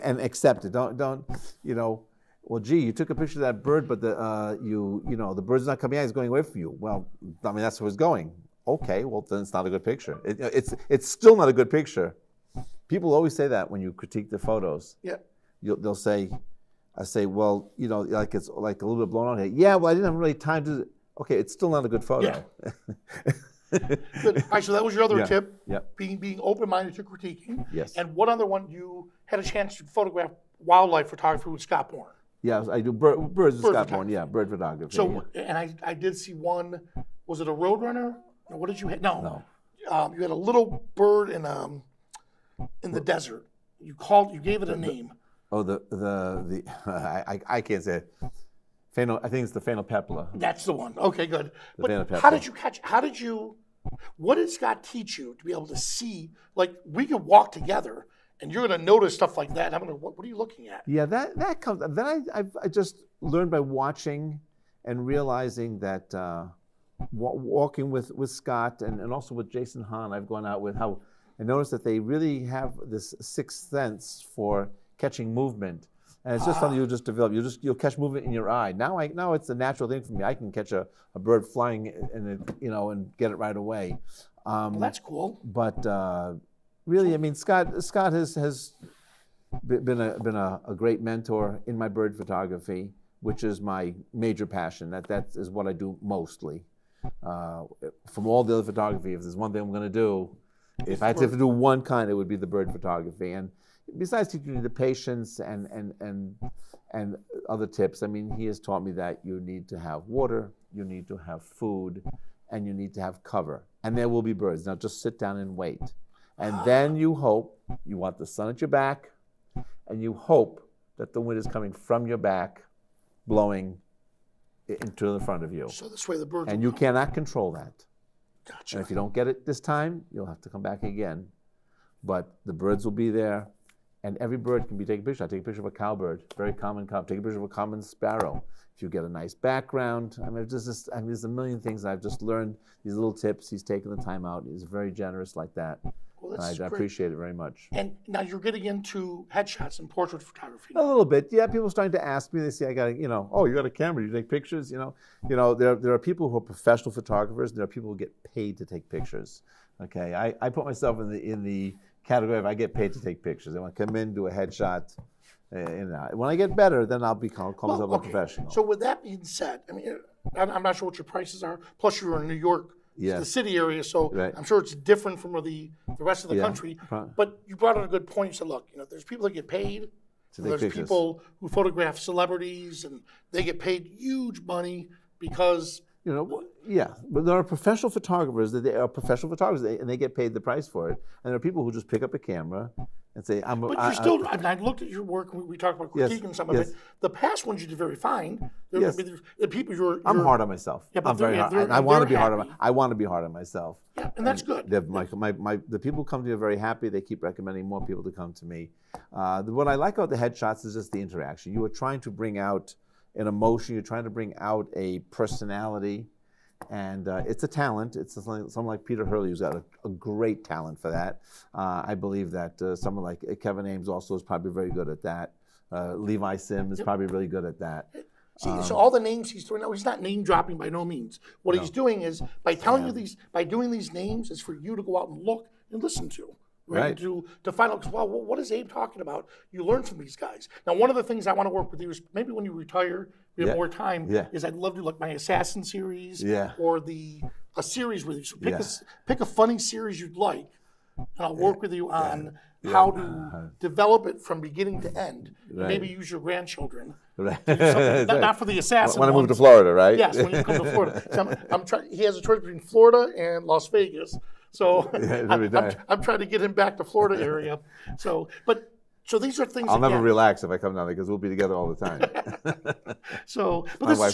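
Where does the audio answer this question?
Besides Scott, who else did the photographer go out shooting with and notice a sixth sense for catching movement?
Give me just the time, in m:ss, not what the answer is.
1:09.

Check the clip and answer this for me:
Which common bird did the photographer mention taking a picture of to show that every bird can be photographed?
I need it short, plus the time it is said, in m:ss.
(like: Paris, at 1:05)
cowbird, at 2:15.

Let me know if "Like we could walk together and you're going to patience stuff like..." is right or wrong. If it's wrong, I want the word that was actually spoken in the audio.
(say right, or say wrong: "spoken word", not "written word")
wrong: "notice", not "patience".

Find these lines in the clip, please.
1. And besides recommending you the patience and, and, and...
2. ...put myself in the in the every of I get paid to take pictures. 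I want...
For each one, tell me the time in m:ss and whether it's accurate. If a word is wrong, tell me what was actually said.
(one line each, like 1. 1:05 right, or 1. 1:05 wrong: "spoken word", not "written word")
1. 1:43 wrong: "teaching", not "recommending"
2. 2:40 wrong: "category", not "every".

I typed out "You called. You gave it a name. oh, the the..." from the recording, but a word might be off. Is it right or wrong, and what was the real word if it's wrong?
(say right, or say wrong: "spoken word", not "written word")
right.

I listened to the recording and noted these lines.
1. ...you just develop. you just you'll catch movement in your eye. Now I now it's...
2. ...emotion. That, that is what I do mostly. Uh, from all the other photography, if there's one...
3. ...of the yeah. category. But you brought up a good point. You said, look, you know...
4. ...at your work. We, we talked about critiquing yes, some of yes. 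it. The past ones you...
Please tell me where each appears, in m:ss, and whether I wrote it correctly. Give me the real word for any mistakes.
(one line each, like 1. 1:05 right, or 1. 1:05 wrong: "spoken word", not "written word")
1. 1:16 right
2. 1:34 wrong: "passion", not "emotion"
3. 2:56 wrong: "country", not "category"
4. 3:14 right.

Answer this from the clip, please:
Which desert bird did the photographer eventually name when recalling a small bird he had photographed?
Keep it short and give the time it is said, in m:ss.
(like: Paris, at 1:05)
Phainopepla, at 0:49.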